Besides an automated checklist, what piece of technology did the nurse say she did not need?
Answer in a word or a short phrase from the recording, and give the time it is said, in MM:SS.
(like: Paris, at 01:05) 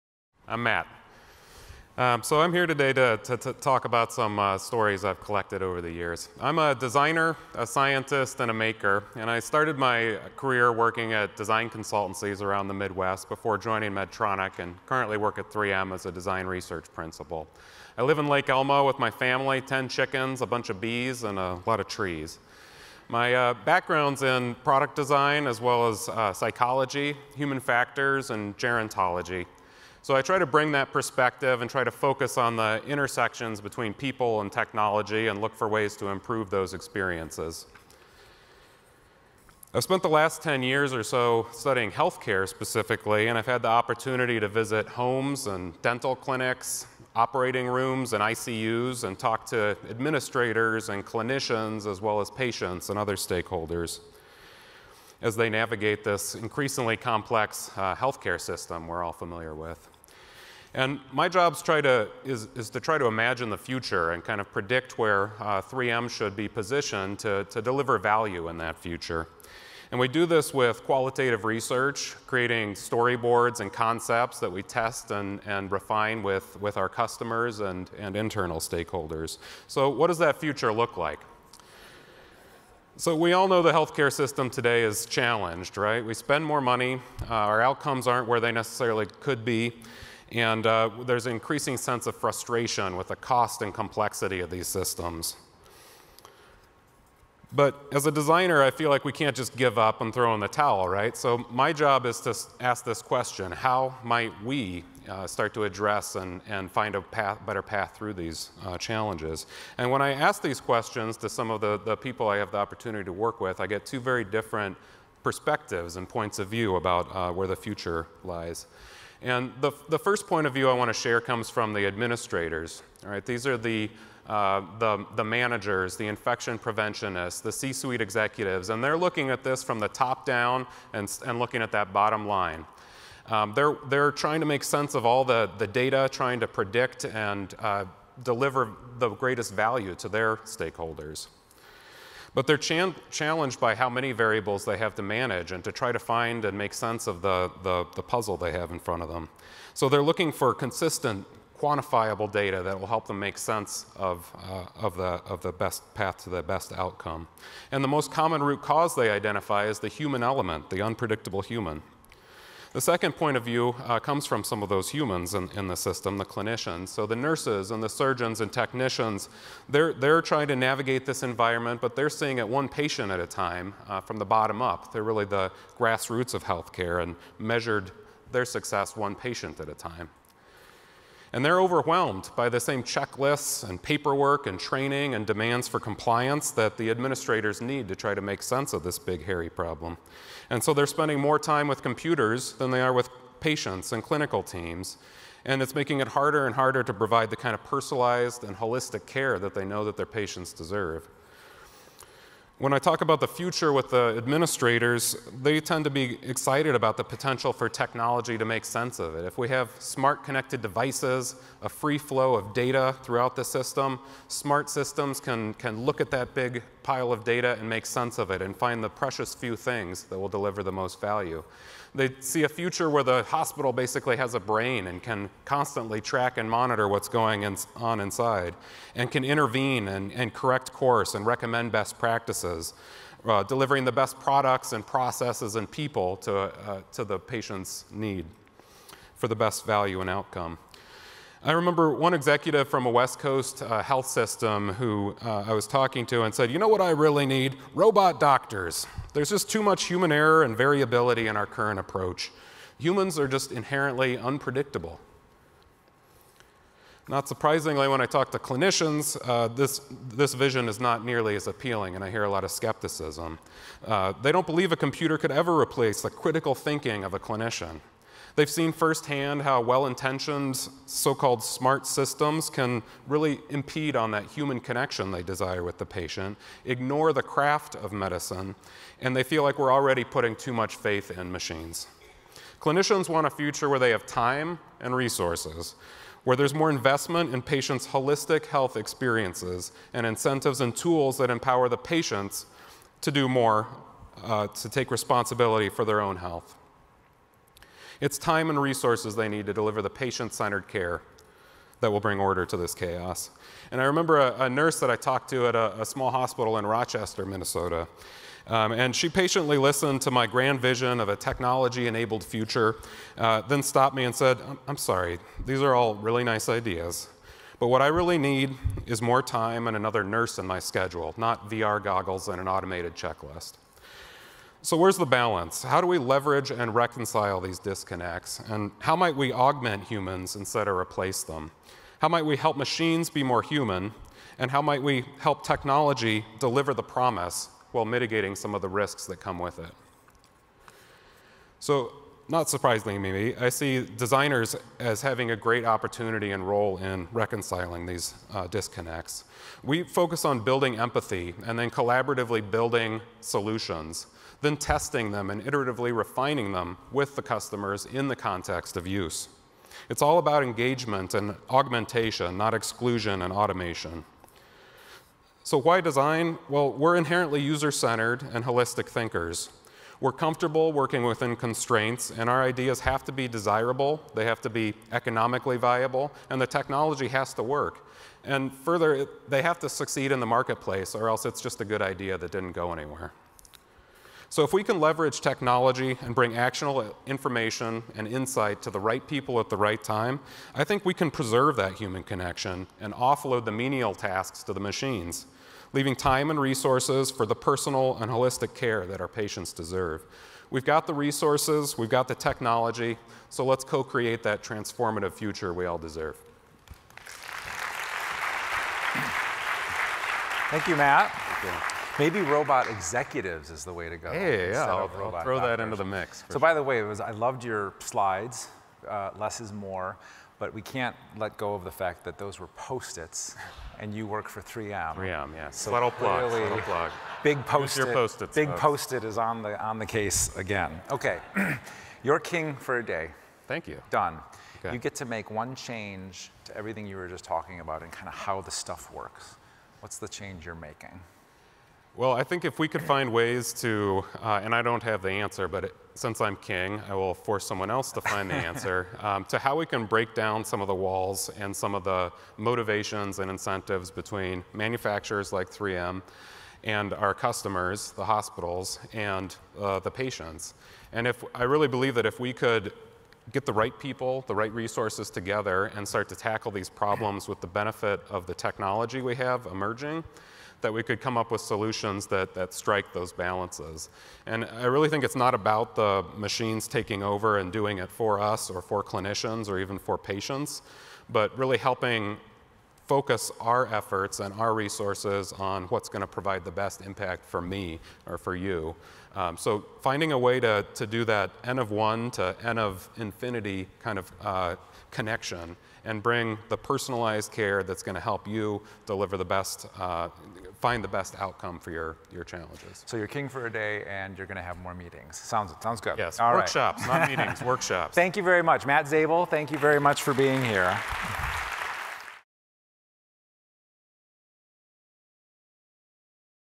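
VR goggles, at 05:21.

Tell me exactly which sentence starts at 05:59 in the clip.
It's all about engagement and augmentation, not exclusion and automation.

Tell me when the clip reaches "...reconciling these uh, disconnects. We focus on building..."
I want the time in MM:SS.
05:47.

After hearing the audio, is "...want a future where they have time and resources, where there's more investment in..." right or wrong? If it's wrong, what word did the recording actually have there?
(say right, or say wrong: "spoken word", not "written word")
right.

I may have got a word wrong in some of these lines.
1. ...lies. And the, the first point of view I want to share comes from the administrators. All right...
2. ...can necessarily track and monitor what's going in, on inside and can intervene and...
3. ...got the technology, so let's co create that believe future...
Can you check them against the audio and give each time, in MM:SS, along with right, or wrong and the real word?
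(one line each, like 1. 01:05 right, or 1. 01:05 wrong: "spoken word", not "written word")
1. 01:58 right
2. 03:45 wrong: "constantly", not "necessarily"
3. 06:41 wrong: "transformative", not "believe".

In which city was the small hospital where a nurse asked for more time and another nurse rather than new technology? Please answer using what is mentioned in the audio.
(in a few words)
Rochester, Minnesota.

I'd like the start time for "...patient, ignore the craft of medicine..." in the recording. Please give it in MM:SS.
04:35.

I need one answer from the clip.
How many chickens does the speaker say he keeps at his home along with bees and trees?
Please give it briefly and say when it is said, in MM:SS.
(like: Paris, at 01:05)
10, at 00:19.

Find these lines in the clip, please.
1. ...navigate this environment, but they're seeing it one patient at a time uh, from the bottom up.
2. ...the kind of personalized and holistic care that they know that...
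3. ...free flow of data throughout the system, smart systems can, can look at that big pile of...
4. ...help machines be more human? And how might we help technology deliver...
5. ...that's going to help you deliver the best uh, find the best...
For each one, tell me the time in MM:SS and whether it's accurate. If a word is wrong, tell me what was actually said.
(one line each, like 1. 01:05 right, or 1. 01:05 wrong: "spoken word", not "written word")
1. 02:50 right
2. 03:17 right
3. 03:31 right
4. 05:32 right
5. 08:17 right.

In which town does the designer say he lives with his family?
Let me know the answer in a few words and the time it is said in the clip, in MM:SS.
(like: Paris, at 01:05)
Lake Elmo, at 00:18.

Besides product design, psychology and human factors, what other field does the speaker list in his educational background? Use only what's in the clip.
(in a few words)
gerontology.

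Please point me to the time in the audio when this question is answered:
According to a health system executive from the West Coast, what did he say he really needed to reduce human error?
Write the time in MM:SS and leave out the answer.
04:07.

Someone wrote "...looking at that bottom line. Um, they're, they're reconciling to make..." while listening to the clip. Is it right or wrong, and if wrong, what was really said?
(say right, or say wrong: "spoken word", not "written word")
wrong: "trying", not "reconciling".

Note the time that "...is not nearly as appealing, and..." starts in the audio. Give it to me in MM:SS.
04:20.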